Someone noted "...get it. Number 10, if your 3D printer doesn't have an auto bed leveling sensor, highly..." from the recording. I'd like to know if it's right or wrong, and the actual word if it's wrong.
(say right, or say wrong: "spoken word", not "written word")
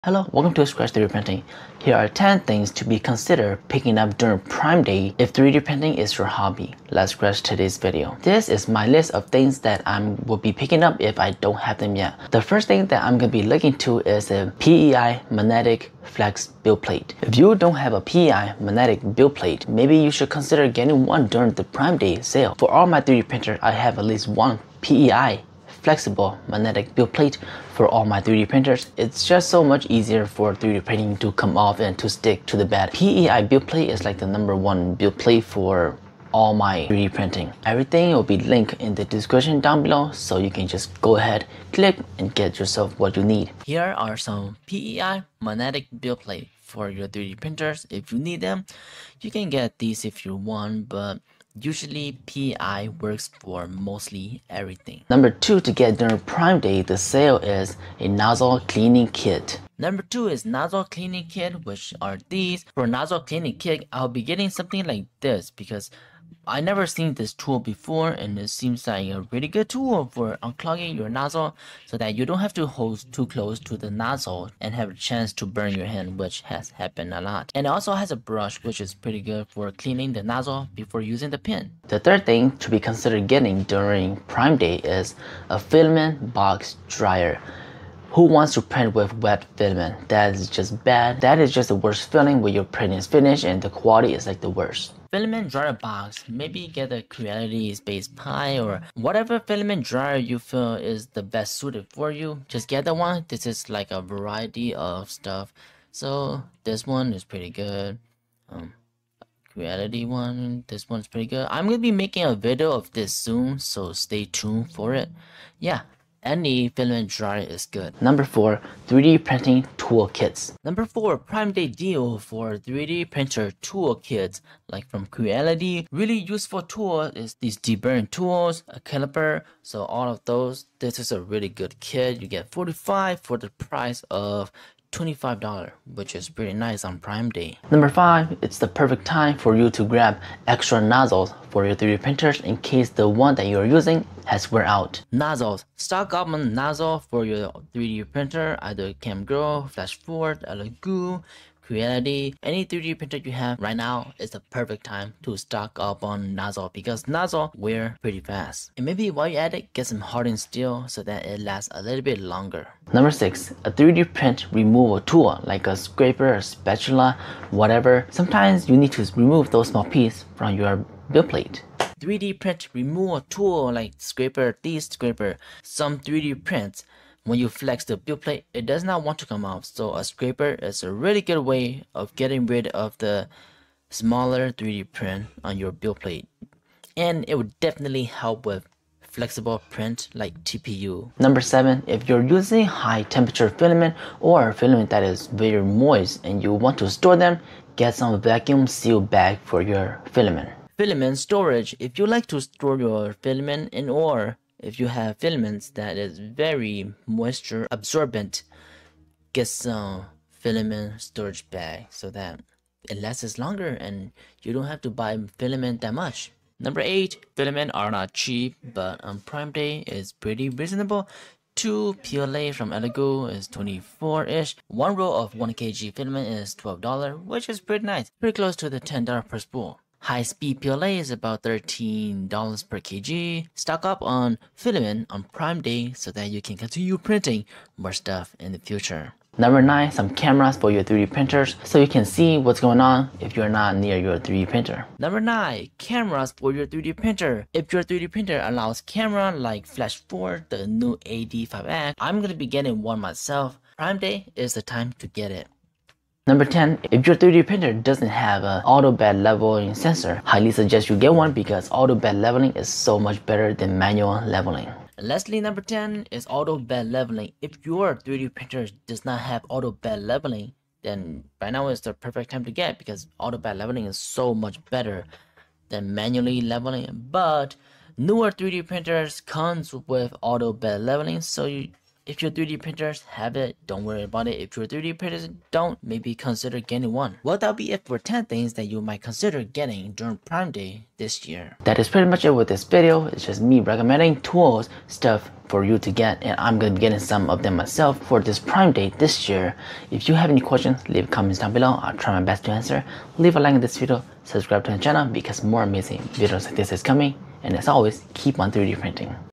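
right.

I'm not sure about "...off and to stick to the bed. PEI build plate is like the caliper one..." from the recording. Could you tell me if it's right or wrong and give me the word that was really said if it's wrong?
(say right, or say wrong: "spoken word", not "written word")
wrong: "number", not "caliper".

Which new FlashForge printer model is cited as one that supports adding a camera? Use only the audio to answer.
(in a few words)
AD5X.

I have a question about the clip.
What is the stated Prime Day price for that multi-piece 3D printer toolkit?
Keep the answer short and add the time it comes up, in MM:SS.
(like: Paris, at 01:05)
$25, at 02:14.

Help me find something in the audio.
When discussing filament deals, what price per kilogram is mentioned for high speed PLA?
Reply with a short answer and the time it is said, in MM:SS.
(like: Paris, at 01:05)
$13, at 03:51.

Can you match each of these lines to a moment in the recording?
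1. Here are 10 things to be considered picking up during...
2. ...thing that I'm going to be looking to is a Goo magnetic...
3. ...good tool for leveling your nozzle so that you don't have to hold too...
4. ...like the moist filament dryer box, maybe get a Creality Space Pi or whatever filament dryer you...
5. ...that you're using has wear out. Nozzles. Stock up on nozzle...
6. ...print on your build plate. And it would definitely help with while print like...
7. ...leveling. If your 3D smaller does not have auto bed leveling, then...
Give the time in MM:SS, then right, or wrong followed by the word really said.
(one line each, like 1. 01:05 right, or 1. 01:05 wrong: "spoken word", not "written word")
1. 00:01 right
2. 00:12 wrong: "PEI", not "Goo"
3. 01:09 wrong: "unclogging", not "leveling"
4. 01:34 wrong: "worst", not "moist"
5. 02:23 right
6. 03:04 wrong: "flexible", not "while"
7. 04:26 wrong: "printer", not "smaller".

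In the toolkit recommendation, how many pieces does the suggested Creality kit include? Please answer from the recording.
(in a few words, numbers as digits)
45.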